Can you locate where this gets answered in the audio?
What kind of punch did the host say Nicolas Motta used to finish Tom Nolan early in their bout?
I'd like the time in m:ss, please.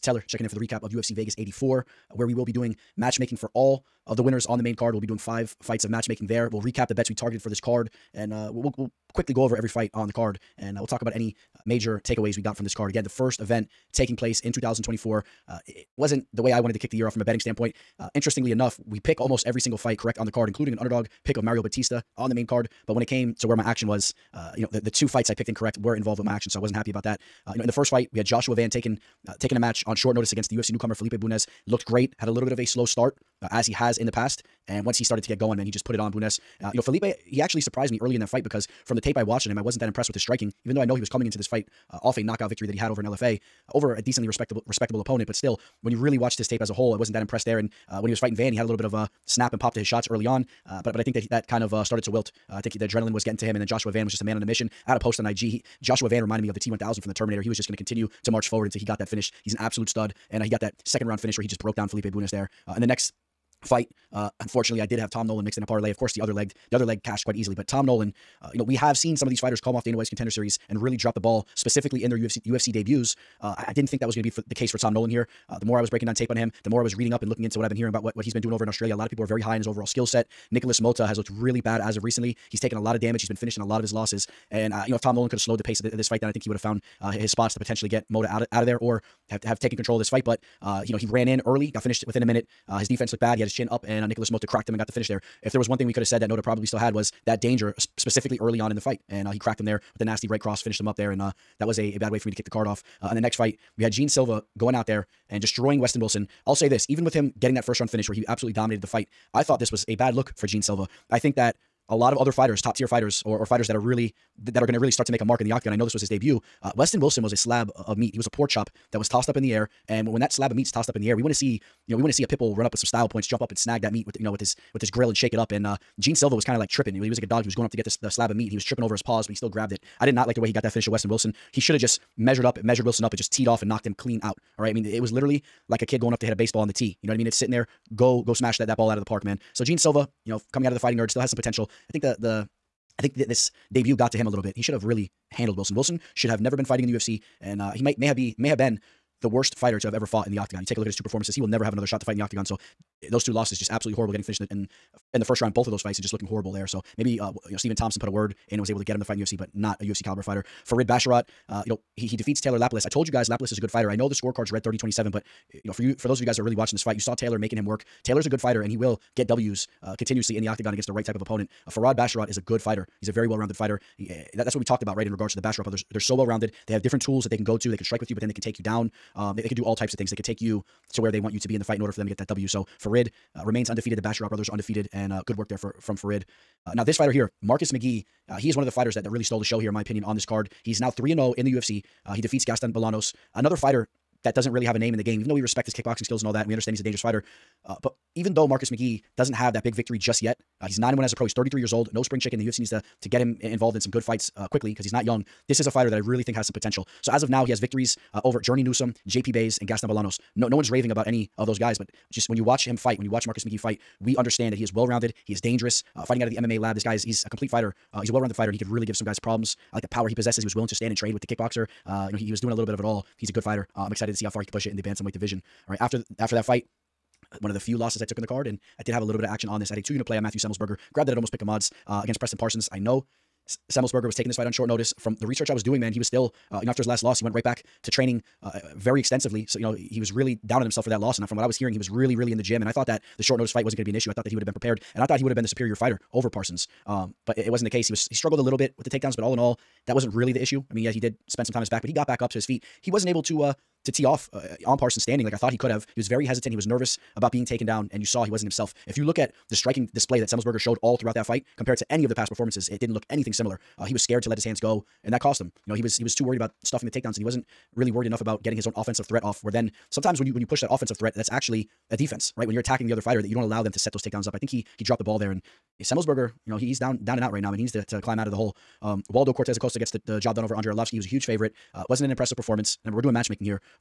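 1:40.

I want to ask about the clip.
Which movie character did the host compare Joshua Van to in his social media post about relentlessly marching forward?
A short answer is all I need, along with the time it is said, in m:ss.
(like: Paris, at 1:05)
T1000, at 0:56.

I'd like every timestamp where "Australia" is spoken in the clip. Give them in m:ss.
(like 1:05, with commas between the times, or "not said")
1:18.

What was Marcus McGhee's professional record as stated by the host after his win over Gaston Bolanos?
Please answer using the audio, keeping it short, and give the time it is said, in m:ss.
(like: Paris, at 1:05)
9 and 1, at 3:20.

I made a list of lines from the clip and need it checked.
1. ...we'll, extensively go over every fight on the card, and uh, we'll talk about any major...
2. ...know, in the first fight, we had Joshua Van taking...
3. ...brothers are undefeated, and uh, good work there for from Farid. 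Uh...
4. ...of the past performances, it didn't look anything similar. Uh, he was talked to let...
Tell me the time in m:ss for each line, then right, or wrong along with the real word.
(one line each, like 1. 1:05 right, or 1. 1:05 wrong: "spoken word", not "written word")
1. 0:08 wrong: "quickly", not "extensively"
2. 0:27 right
3. 3:04 right
4. 4:22 wrong: "scared", not "talked".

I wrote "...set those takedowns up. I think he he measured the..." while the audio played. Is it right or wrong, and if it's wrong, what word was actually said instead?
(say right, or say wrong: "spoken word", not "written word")
wrong: "dropped", not "measured".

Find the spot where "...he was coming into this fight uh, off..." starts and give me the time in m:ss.
0:40.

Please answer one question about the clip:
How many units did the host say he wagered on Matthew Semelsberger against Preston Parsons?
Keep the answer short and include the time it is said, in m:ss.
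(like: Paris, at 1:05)
2, at 3:49.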